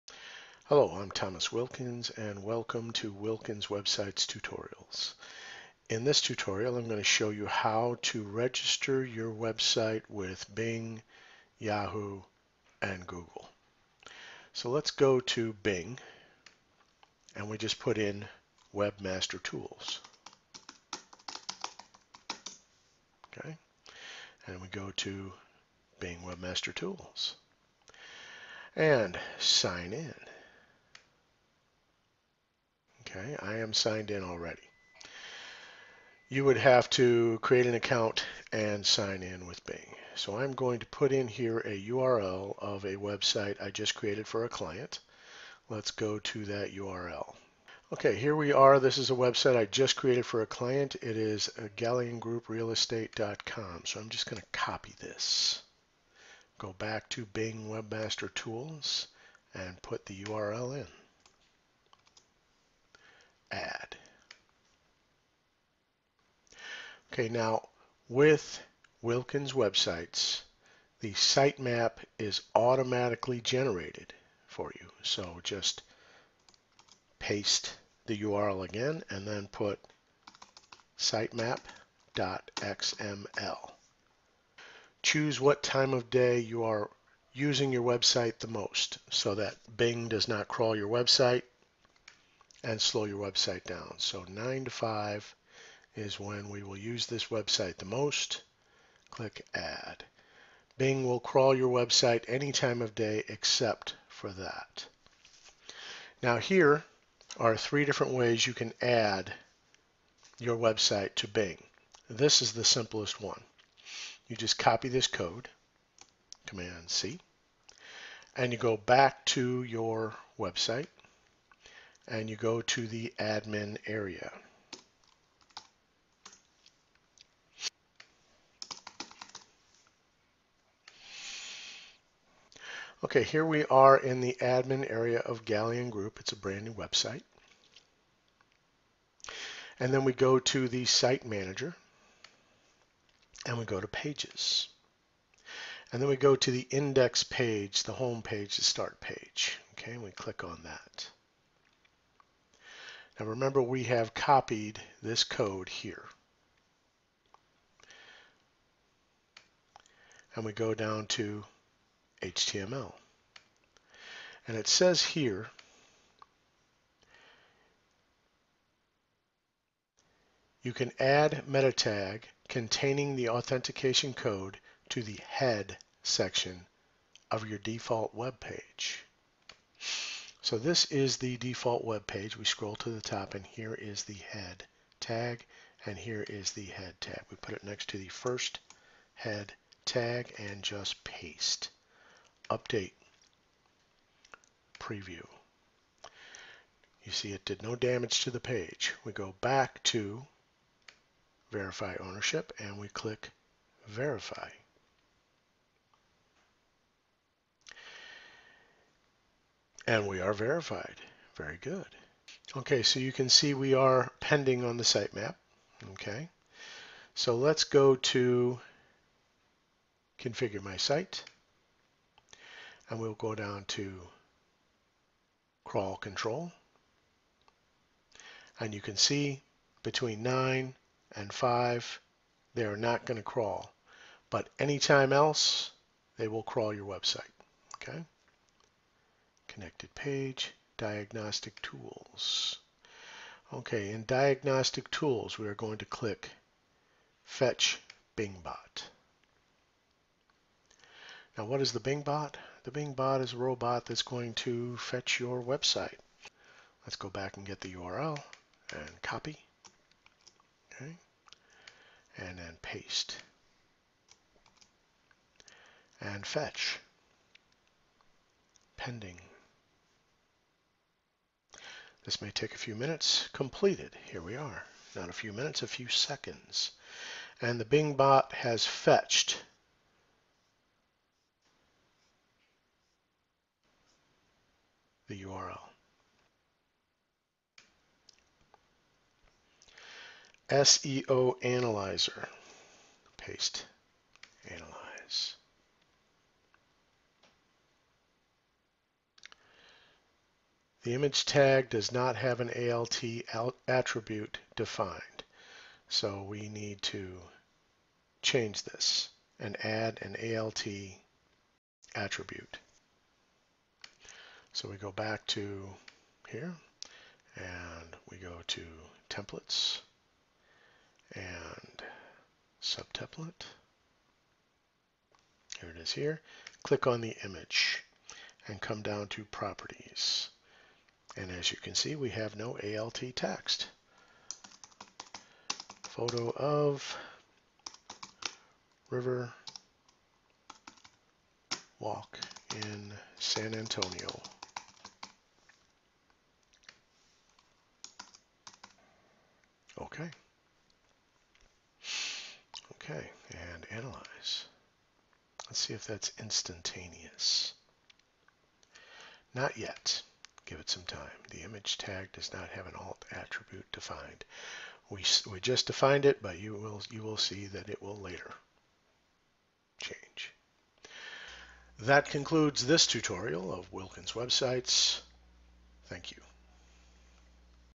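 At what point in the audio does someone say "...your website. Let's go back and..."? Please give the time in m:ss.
4:15.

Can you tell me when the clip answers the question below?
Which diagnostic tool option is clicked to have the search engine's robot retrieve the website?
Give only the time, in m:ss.
4:07.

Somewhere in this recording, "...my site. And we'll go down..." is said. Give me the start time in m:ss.
3:40.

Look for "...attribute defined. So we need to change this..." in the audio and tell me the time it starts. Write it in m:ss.
5:03.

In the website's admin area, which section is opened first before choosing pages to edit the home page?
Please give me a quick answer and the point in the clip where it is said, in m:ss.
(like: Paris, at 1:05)
site manager, at 2:20.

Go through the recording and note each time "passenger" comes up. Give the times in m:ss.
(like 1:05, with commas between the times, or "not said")
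not said.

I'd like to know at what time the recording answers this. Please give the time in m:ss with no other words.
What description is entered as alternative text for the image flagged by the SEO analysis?
5:35.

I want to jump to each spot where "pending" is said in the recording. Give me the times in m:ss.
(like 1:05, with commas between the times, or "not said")
3:34, 4:28.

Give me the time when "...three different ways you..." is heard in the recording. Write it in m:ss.
1:47.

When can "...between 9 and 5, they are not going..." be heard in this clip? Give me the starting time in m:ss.
3:49.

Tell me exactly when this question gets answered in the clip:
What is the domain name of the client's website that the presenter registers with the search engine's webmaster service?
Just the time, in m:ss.
0:51.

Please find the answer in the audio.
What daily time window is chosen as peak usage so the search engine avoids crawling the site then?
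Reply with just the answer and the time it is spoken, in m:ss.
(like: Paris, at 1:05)
9 to 5, at 1:34.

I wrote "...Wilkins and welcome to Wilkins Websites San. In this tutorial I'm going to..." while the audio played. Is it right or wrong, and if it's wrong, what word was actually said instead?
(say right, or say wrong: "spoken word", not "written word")
wrong: "Tutorials", not "San".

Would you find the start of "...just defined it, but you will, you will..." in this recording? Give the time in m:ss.
6:05.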